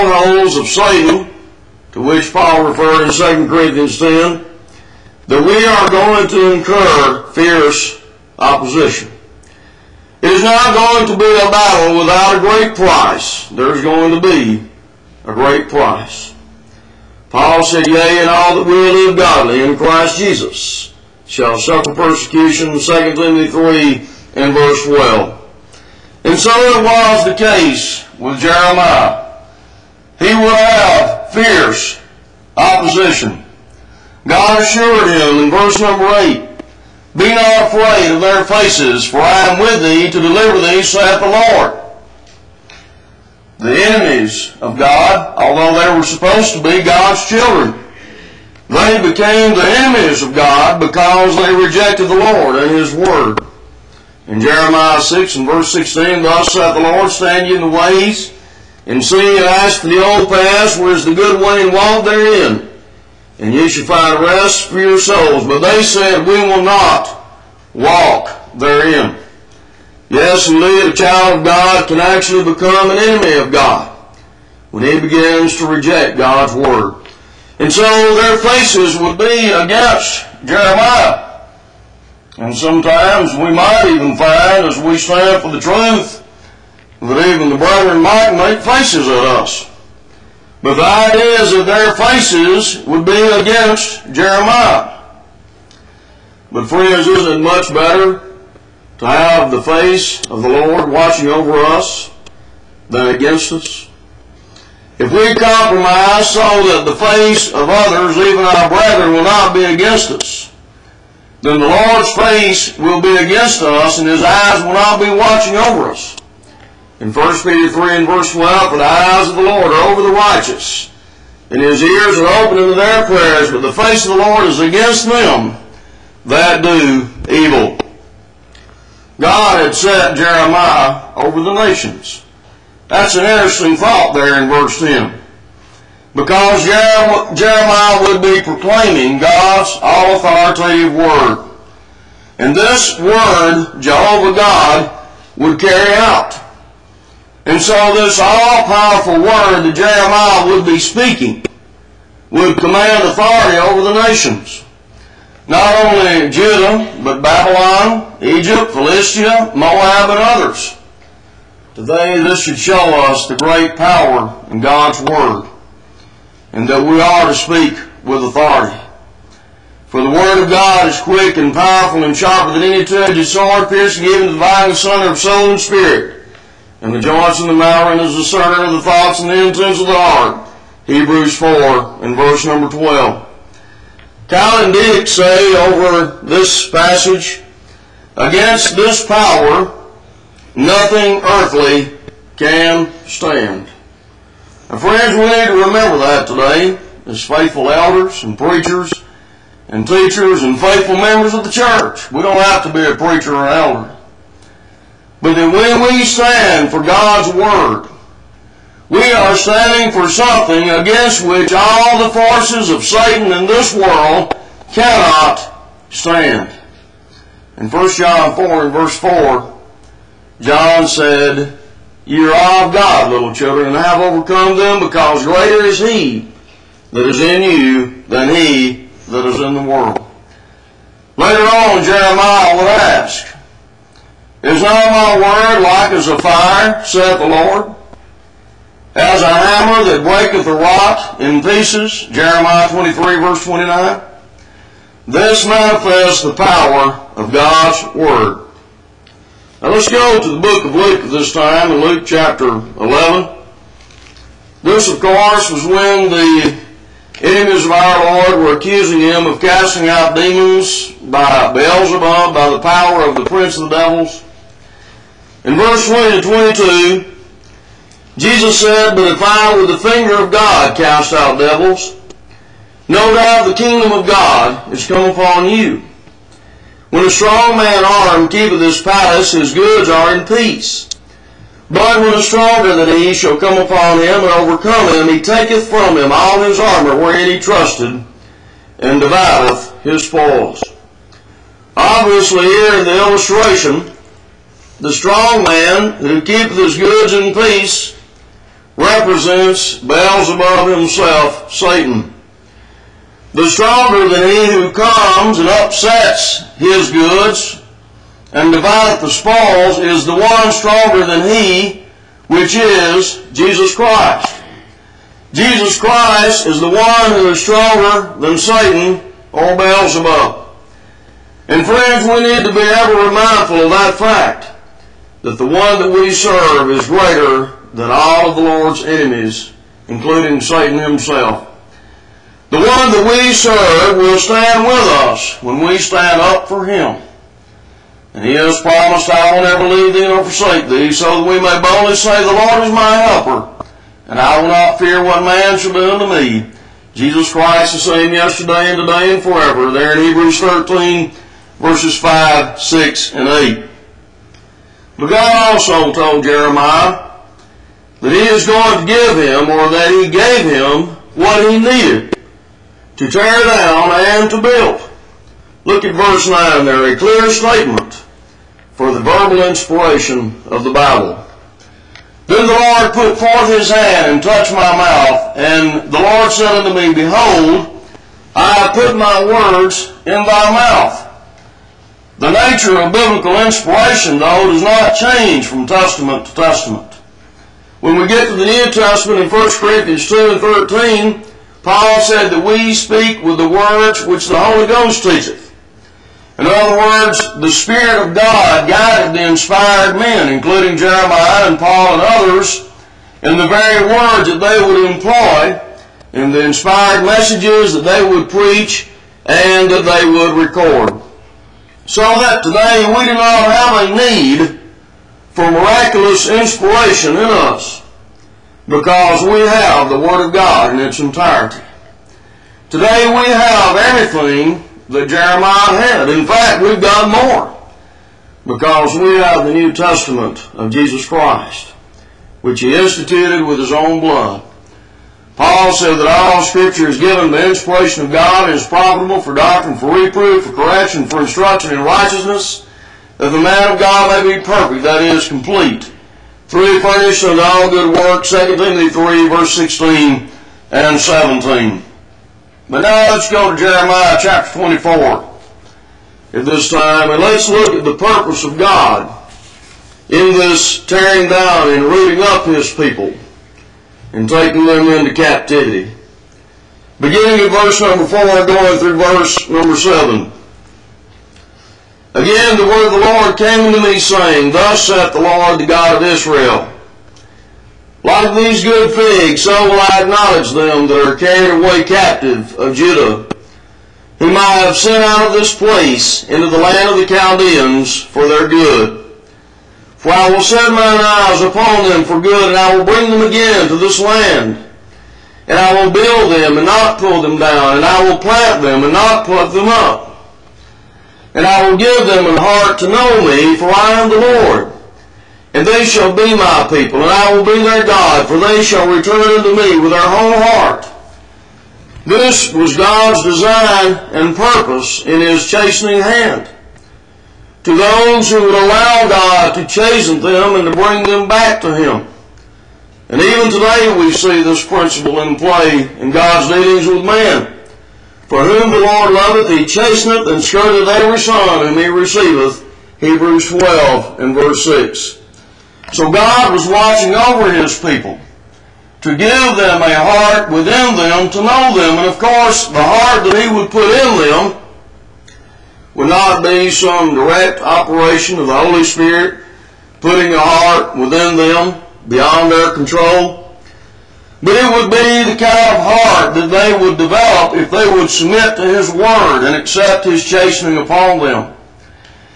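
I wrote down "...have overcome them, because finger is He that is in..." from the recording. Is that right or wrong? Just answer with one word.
wrong.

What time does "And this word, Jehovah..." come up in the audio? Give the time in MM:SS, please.
02:22.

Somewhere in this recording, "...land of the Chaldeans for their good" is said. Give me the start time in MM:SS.
08:06.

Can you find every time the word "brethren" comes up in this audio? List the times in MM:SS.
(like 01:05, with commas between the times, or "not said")
01:27, 01:48.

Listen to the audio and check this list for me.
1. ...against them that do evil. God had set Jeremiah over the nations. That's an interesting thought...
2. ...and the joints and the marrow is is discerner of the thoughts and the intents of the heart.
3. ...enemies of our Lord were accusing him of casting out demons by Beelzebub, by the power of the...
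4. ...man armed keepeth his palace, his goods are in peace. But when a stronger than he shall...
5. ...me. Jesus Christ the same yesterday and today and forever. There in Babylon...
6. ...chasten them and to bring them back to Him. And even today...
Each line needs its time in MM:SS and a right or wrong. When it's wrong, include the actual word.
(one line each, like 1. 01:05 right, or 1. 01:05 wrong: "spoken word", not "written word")
1. 02:04 right
2. 02:56 right
3. 04:17 right
4. 04:37 right
5. 05:46 wrong: "Hebrews", not "Babylon"
6. 08:39 right.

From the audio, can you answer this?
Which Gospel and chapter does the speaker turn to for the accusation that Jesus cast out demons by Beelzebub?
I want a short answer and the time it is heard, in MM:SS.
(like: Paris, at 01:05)
Luke 11, at 04:11.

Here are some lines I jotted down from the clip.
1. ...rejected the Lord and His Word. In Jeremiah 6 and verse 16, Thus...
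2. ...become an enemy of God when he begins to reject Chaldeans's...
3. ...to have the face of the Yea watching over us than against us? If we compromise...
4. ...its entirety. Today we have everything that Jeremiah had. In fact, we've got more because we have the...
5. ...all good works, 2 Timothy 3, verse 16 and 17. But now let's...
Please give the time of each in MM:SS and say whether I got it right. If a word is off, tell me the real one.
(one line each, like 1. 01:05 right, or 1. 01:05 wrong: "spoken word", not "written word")
1. 00:51 right
2. 01:12 wrong: "God", not "Chaldeans"
3. 01:38 wrong: "Lord", not "Yea"
4. 07:00 right
5. 07:27 right.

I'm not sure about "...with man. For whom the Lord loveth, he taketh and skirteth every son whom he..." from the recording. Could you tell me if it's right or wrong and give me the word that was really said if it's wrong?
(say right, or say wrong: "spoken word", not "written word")
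wrong: "chasteneth", not "taketh".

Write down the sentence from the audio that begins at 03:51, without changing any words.
Later on, Jeremiah would ask, is not my word like as a fire, saith the Lord?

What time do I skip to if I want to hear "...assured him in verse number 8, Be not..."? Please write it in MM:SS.
00:34.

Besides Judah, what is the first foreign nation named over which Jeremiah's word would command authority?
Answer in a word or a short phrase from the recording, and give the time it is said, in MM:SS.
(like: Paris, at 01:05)
Babylon, at 02:37.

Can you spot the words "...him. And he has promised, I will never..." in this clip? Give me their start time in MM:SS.
05:36.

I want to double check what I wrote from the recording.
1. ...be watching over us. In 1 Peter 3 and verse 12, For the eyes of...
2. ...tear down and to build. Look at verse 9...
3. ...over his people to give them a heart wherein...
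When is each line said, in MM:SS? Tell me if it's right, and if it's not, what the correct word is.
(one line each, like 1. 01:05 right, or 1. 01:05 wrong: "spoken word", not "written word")
1. 01:54 right
2. 06:03 right
3. 08:57 wrong: "within", not "wherein".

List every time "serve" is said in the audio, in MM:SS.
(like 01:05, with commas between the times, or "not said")
05:26, 05:33.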